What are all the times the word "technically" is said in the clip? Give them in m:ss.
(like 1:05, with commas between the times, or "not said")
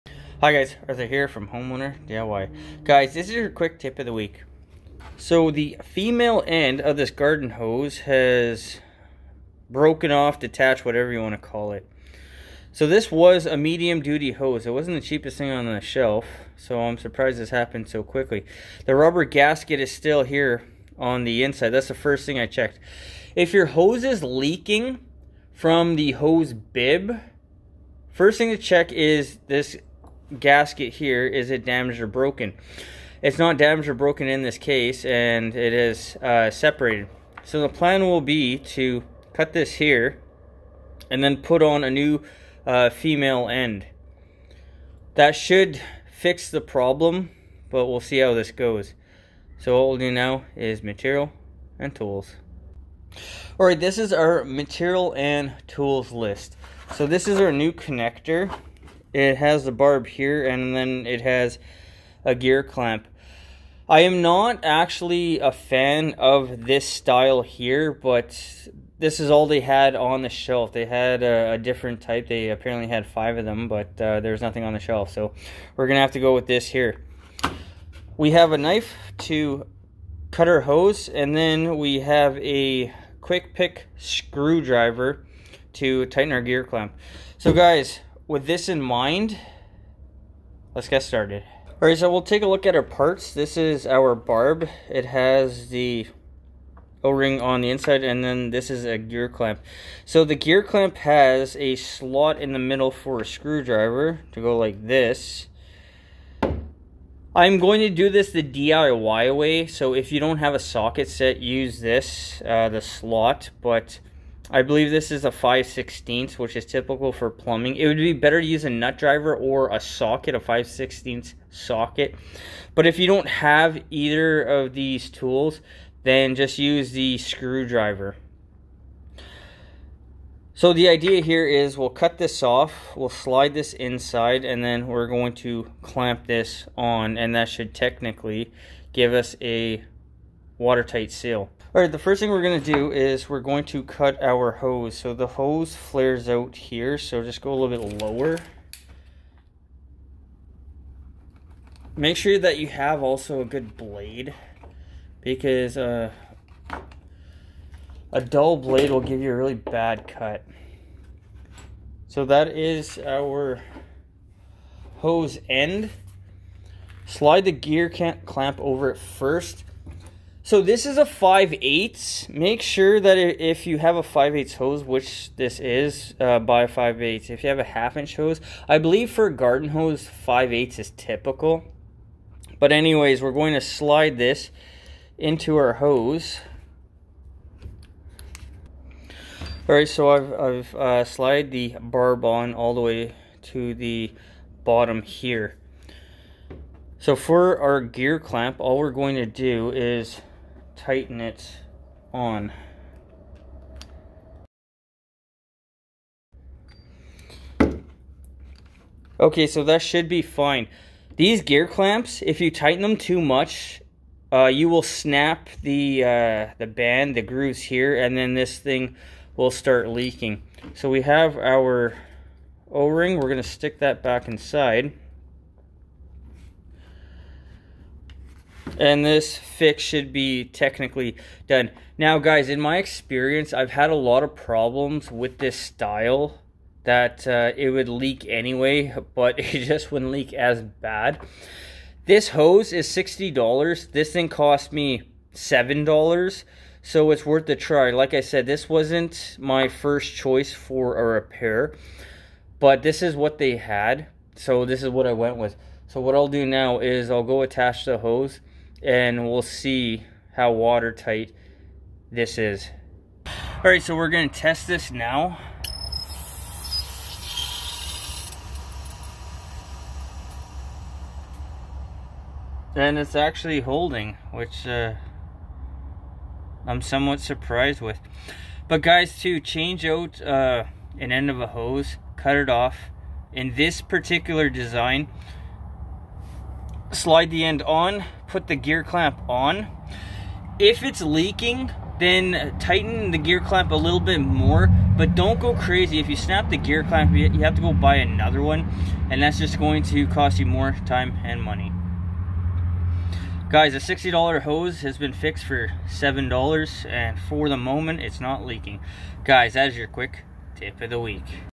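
2:17, 3:50.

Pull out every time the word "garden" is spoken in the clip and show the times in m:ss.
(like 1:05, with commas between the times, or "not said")
0:07, 2:59.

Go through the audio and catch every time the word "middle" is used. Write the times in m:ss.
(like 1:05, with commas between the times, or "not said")
1:42.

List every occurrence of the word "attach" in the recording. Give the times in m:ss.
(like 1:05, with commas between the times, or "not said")
4:17.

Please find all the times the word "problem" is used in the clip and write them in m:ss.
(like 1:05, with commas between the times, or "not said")
0:46, 3:54.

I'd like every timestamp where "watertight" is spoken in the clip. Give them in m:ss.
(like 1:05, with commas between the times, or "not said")
2:20, 4:20.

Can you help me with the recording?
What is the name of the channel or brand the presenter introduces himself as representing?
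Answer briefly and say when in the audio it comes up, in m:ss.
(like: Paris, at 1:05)
Homeowner DIY, at 0:01.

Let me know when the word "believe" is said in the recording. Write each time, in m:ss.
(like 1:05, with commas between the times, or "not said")
1:54, 2:58.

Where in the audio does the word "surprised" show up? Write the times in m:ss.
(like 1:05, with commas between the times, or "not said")
0:16, 4:37.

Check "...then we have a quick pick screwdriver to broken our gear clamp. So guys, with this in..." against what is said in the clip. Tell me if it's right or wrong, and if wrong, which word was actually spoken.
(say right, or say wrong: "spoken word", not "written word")
wrong: "tighten", not "broken".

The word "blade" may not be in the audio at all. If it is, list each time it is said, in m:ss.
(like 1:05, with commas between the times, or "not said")
2:33, 2:38.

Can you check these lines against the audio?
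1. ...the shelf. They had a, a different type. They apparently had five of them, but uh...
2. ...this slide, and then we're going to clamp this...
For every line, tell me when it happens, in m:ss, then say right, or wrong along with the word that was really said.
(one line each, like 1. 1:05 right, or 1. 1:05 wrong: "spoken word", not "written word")
1. 1:10 right
2. 2:13 wrong: "inside", not "slide".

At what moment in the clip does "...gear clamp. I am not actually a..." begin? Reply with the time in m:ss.
1:02.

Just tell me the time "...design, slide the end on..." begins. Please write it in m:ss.
4:44.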